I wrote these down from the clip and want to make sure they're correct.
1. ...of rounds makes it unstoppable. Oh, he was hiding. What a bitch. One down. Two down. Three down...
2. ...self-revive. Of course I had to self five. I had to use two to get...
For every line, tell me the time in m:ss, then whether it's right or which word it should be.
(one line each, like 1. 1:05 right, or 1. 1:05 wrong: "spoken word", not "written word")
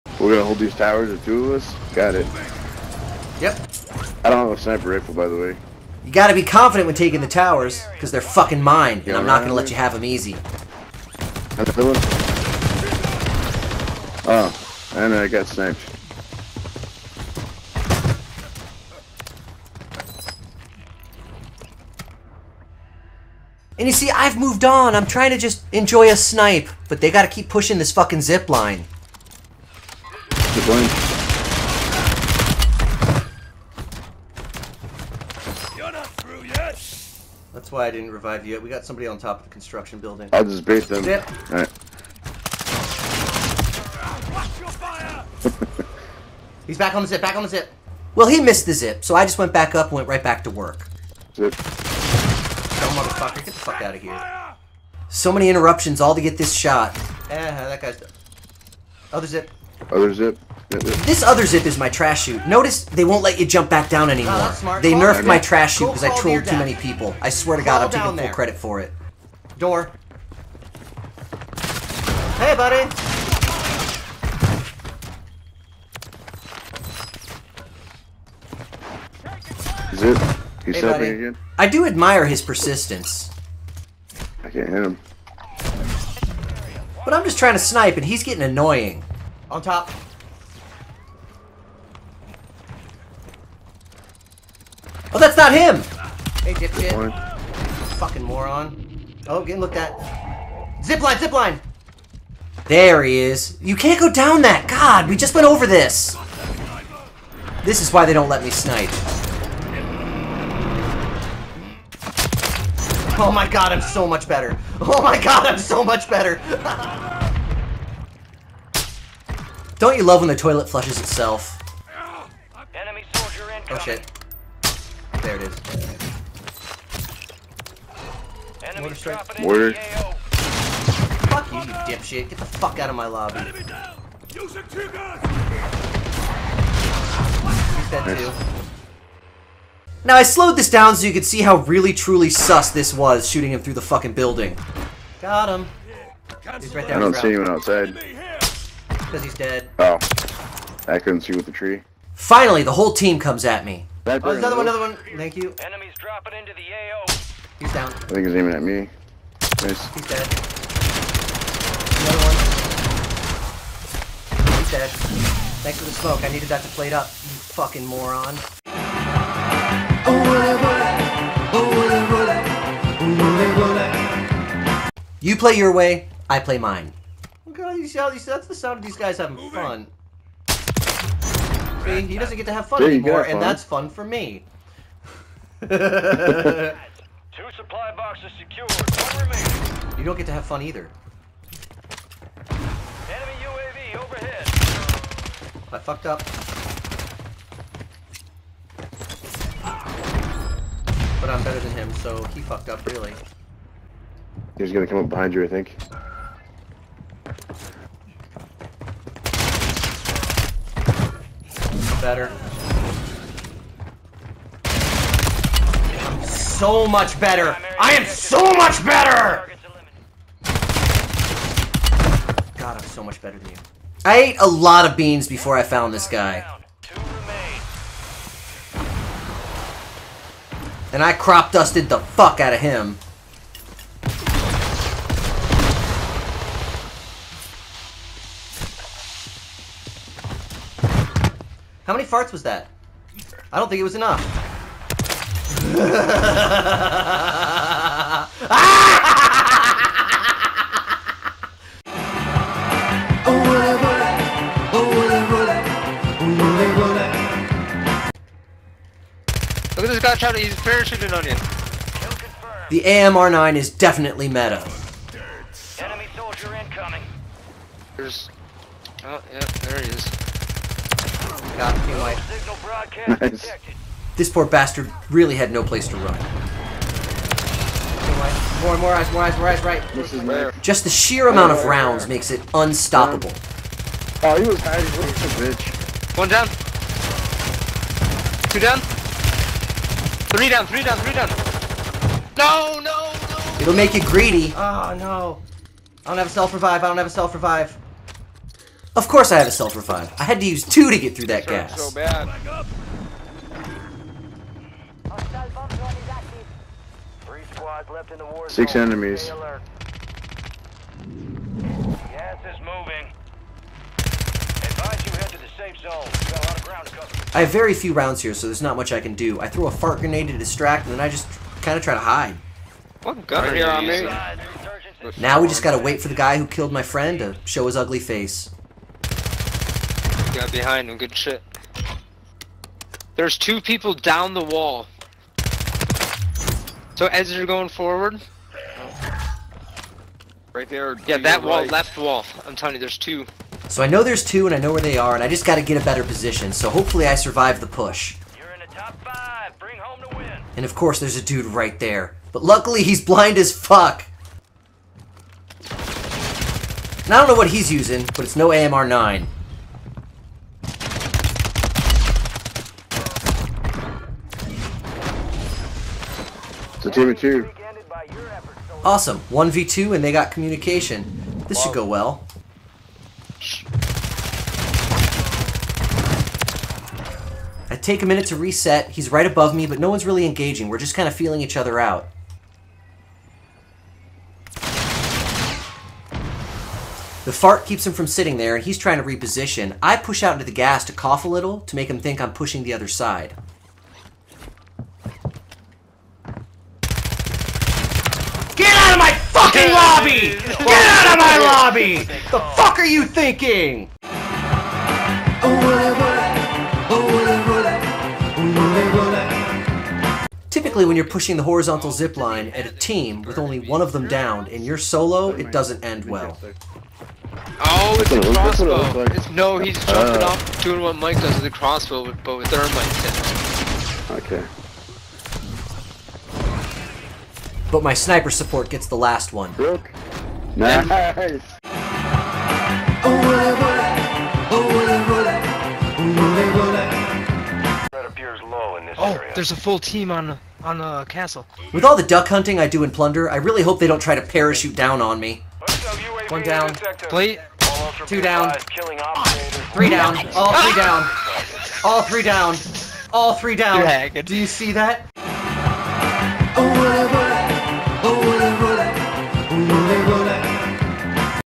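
1. 4:41 right
2. 4:57 right.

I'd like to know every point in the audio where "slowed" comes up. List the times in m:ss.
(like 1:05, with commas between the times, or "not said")
2:20.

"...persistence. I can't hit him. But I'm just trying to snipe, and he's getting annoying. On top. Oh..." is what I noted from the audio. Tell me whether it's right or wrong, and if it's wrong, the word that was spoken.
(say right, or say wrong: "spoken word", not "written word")
right.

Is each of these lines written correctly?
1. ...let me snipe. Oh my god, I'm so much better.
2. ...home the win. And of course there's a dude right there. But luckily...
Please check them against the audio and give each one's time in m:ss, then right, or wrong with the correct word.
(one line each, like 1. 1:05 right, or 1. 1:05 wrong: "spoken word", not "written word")
1. 1:48 right
2. 5:49 right.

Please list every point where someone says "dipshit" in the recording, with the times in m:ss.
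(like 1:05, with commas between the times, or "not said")
1:36, 2:11.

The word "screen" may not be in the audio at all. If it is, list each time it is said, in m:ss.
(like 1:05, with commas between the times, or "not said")
not said.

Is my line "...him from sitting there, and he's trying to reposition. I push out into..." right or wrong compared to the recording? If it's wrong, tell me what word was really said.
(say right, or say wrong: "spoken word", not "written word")
right.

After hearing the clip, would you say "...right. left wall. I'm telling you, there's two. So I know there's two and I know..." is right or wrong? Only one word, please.
right.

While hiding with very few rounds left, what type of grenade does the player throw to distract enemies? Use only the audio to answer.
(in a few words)
Fart grenade.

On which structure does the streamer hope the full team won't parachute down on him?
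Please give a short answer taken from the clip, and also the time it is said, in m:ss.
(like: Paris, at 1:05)
The castle, at 7:21.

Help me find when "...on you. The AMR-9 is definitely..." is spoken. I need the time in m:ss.
4:21.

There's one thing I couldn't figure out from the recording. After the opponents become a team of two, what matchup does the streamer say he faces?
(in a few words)
1v2.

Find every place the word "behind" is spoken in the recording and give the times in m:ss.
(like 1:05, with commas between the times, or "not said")
3:25, 5:30.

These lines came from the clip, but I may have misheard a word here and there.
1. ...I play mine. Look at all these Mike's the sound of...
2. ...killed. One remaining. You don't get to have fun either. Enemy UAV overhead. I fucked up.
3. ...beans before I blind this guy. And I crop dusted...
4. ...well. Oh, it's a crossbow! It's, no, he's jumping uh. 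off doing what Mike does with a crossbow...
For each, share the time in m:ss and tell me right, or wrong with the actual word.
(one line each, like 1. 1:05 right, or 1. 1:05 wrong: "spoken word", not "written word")
1. 2:56 wrong: "That", not "Mike"
2. 3:08 wrong: "secured", not "killed"
3. 3:44 wrong: "found", not "blind"
4. 6:56 right.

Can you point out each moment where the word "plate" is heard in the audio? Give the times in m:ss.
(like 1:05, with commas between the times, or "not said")
2:46, 7:27.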